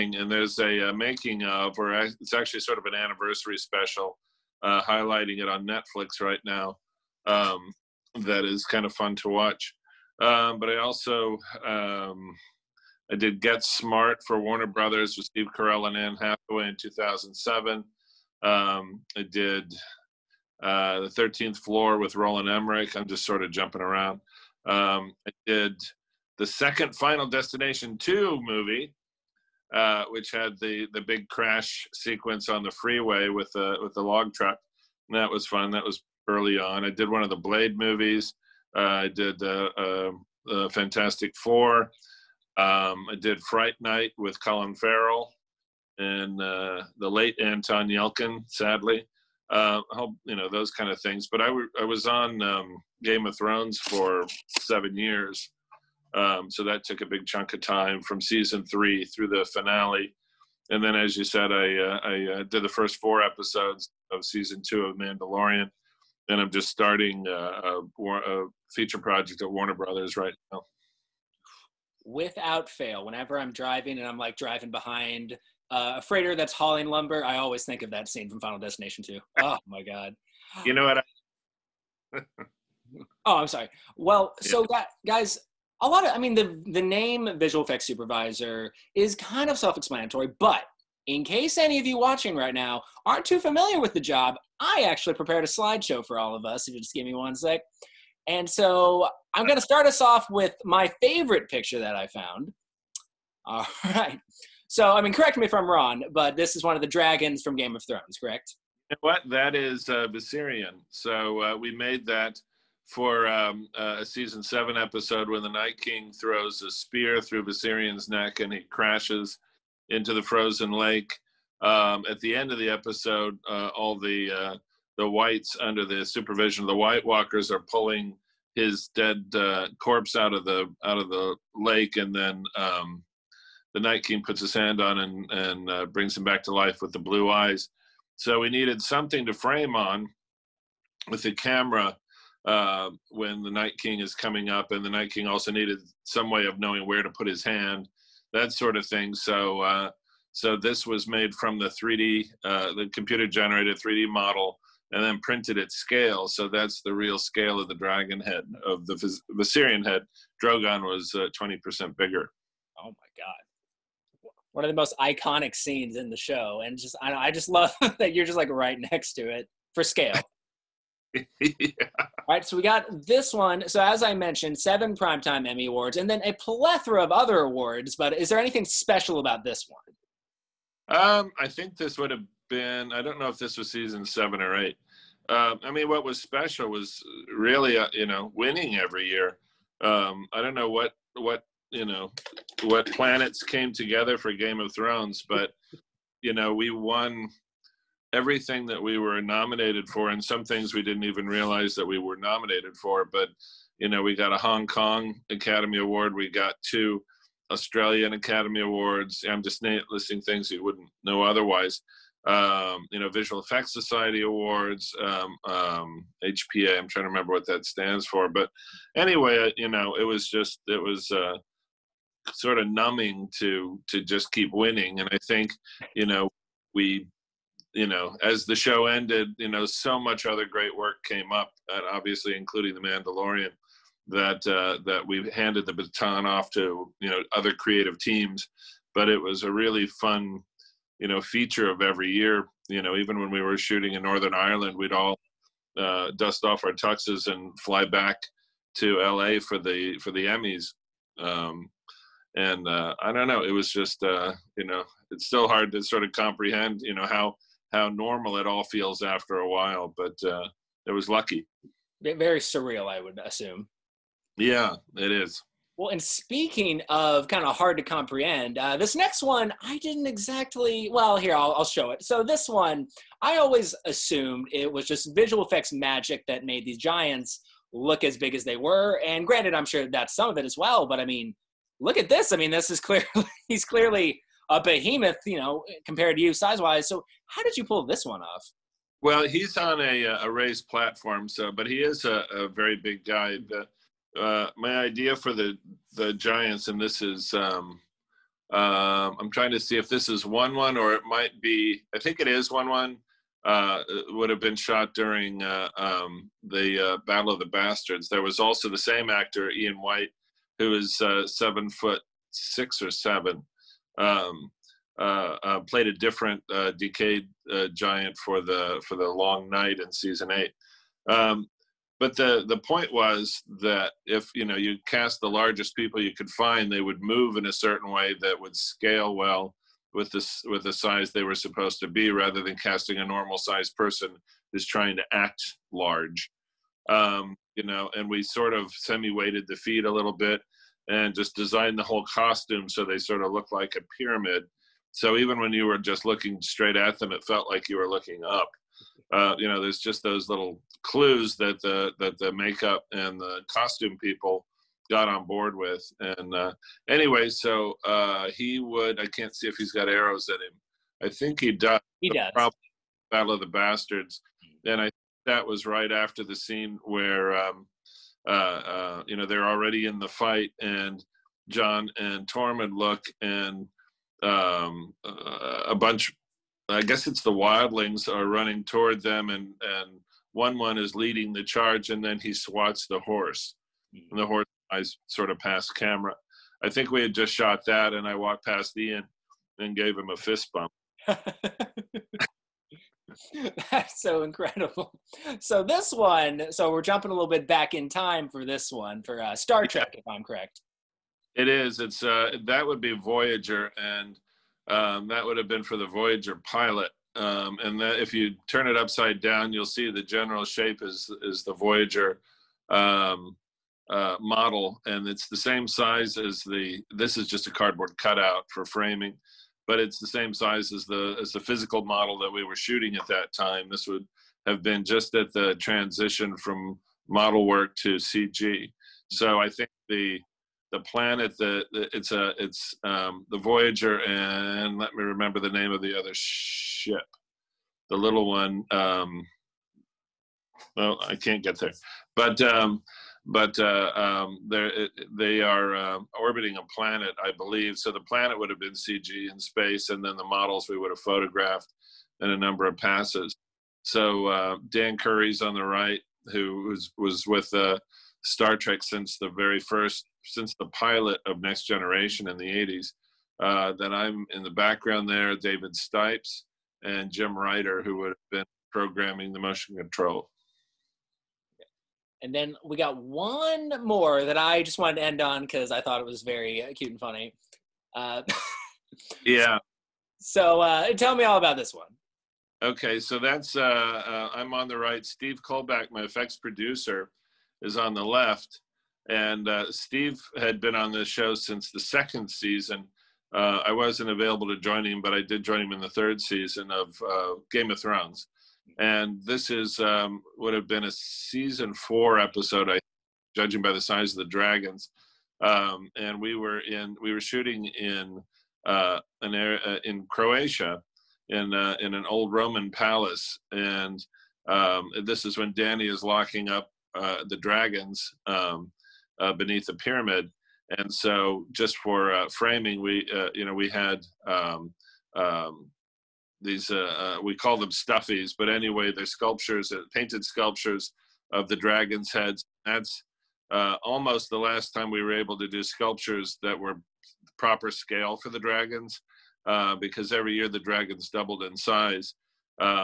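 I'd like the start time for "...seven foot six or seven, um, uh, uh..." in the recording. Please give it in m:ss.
5:11.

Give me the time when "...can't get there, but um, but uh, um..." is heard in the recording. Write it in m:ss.
7:21.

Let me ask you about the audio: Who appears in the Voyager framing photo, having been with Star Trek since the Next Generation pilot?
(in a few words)
Dan Curry.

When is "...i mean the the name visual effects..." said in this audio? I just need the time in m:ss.
1:26.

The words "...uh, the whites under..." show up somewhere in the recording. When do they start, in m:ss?
2:04.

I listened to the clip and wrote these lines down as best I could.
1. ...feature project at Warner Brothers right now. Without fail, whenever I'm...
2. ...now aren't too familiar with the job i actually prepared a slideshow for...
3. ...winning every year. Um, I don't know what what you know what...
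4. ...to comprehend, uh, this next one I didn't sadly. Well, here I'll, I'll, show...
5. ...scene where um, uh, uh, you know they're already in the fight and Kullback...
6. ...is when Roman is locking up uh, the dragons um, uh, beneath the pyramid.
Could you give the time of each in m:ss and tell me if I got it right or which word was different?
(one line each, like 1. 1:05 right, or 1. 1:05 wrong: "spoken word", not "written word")
1. 1:08 right
2. 1:32 right
3. 3:08 right
4. 4:27 wrong: "exactly", not "sadly"
5. 6:06 wrong: "Jon", not "Kullback"
6. 8:35 wrong: "Dany", not "Roman".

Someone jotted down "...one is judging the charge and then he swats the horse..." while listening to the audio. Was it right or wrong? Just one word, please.
wrong.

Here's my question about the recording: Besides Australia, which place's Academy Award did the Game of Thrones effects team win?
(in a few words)
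Hong Kong.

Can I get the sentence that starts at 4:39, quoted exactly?
And granted, I'm sure that's some of it as well.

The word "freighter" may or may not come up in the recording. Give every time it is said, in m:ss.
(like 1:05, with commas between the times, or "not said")
1:16.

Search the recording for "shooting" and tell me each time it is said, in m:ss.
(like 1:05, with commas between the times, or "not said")
4:03, 7:02, 8:27.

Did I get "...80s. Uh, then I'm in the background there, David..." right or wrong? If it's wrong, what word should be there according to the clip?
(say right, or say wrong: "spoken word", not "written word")
right.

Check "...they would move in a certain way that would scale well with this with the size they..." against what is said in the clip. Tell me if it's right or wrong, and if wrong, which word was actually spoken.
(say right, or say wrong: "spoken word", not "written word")
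right.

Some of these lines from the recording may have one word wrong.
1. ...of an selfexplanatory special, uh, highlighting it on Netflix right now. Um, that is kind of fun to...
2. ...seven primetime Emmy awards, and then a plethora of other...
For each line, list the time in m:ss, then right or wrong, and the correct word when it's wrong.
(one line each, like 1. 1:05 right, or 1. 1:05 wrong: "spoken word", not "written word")
1. 0:02 wrong: "anniversary", not "selfexplanatory"
2. 2:54 right.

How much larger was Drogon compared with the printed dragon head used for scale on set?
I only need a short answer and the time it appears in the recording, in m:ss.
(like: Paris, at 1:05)
20%, at 2:41.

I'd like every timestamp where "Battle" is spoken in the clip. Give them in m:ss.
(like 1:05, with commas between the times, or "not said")
5:07, 6:03.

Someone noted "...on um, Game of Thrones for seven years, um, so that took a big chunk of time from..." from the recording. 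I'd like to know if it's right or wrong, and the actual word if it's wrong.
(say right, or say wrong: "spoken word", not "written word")
right.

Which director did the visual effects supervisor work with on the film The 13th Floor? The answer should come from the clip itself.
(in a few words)
Roland Emmerich.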